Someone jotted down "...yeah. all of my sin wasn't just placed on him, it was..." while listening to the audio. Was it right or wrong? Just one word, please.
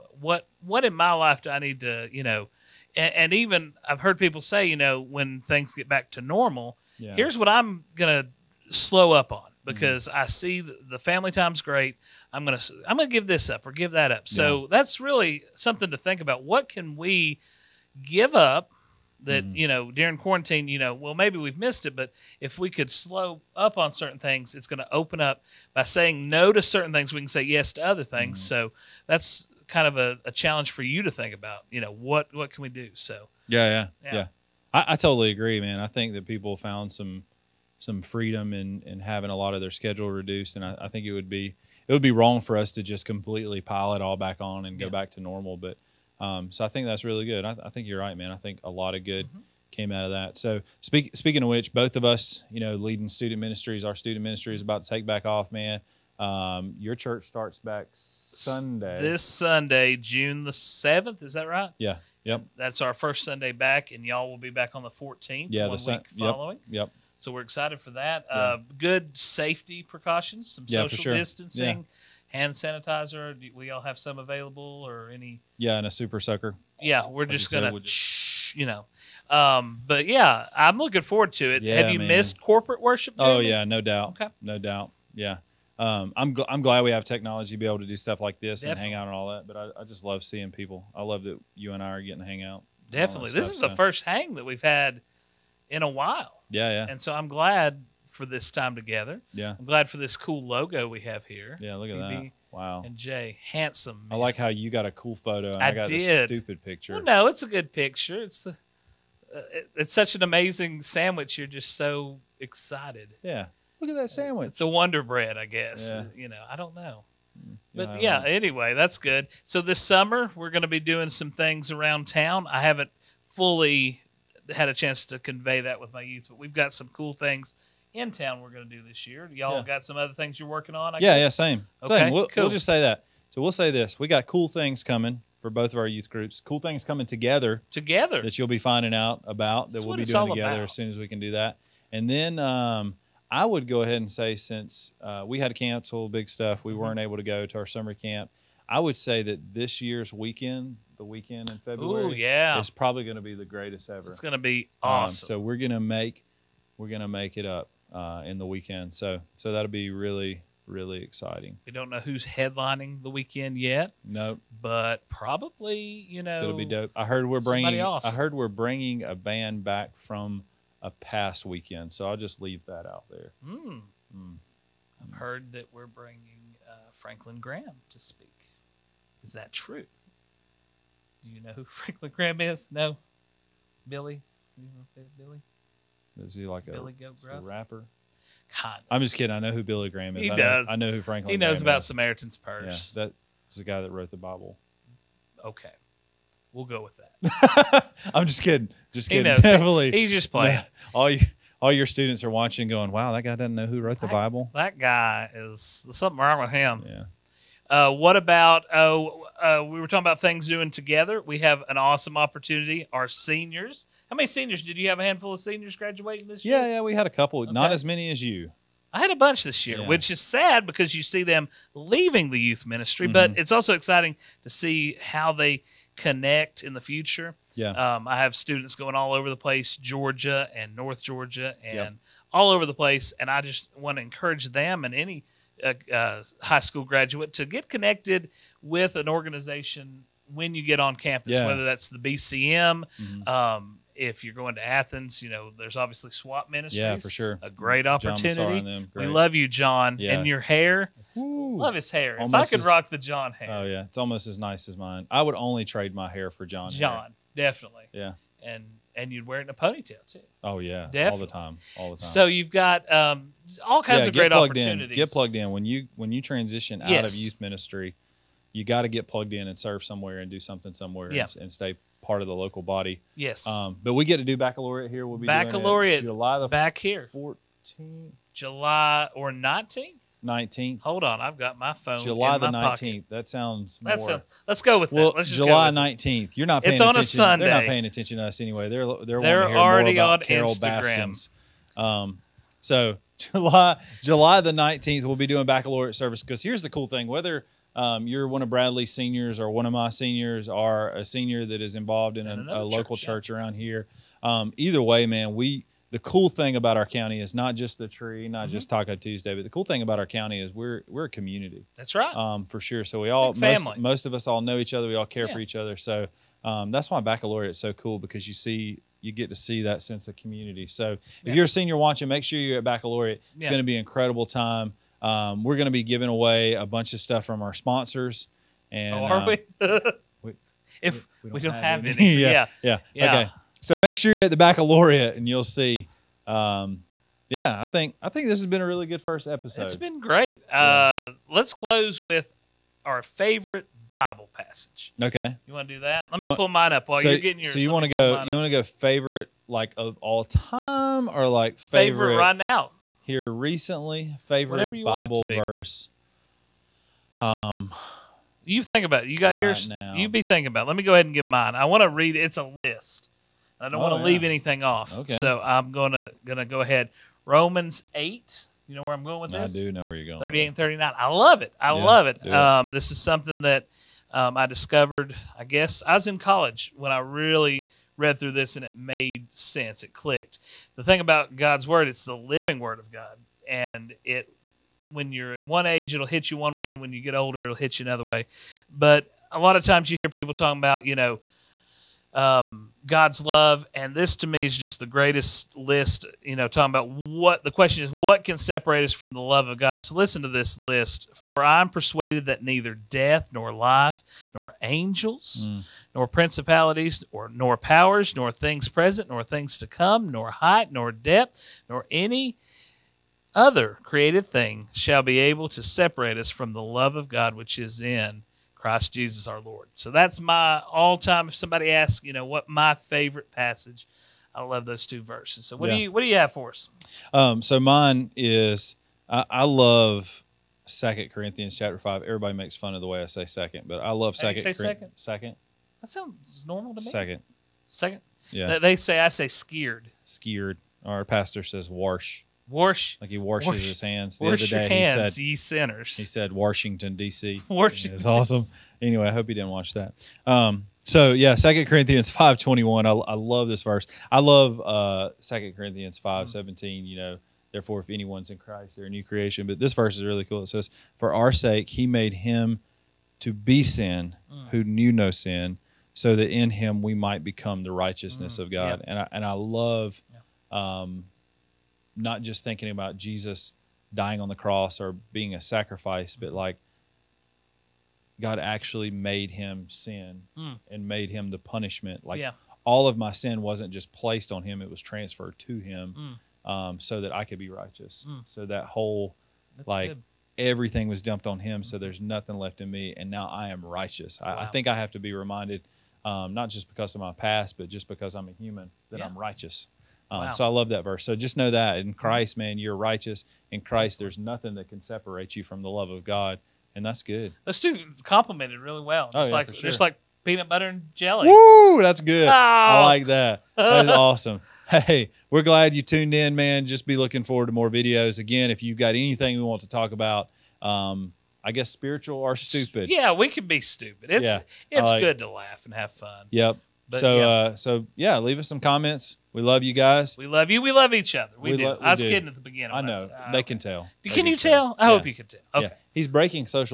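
right.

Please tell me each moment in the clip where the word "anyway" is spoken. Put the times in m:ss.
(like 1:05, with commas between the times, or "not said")
1:58, 4:48, 7:28.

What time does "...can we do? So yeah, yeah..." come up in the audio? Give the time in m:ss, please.
0:32.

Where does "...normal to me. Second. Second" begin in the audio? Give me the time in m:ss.
7:16.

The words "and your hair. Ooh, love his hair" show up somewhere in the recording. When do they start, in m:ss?
4:10.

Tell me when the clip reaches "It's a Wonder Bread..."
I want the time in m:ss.
1:54.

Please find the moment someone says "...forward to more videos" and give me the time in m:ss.
8:37.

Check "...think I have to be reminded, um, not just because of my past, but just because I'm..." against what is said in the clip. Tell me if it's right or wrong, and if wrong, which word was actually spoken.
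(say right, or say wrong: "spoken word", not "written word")
right.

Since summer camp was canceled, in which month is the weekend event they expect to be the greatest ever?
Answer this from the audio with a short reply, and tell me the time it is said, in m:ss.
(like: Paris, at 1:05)
February, at 2:31.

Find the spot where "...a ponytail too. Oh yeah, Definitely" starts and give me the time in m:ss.
4:19.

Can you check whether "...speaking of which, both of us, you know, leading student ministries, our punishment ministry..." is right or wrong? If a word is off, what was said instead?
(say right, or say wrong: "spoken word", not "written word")
wrong: "student", not "punishment".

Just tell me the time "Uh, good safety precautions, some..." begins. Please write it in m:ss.
1:08.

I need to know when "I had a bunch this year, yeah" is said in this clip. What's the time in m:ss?
3:38.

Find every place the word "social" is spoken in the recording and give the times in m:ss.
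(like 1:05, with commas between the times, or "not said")
1:10.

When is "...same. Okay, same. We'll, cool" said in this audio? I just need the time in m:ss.
2:11.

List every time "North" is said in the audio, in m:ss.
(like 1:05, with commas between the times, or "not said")
3:50.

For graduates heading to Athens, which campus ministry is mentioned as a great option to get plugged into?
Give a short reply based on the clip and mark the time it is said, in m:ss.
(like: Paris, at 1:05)
SWAT Ministries, at 4:06.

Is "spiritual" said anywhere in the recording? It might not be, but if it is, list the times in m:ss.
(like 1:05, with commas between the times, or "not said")
8:41.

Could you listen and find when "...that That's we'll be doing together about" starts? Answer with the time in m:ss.
2:19.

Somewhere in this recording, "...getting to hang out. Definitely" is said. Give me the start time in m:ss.
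1:32.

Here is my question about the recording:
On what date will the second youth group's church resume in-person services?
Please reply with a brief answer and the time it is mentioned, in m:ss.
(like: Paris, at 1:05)
the 14th, at 1:04.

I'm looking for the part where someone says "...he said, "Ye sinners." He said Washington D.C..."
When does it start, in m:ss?
7:25.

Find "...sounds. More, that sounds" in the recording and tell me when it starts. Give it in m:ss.
4:43.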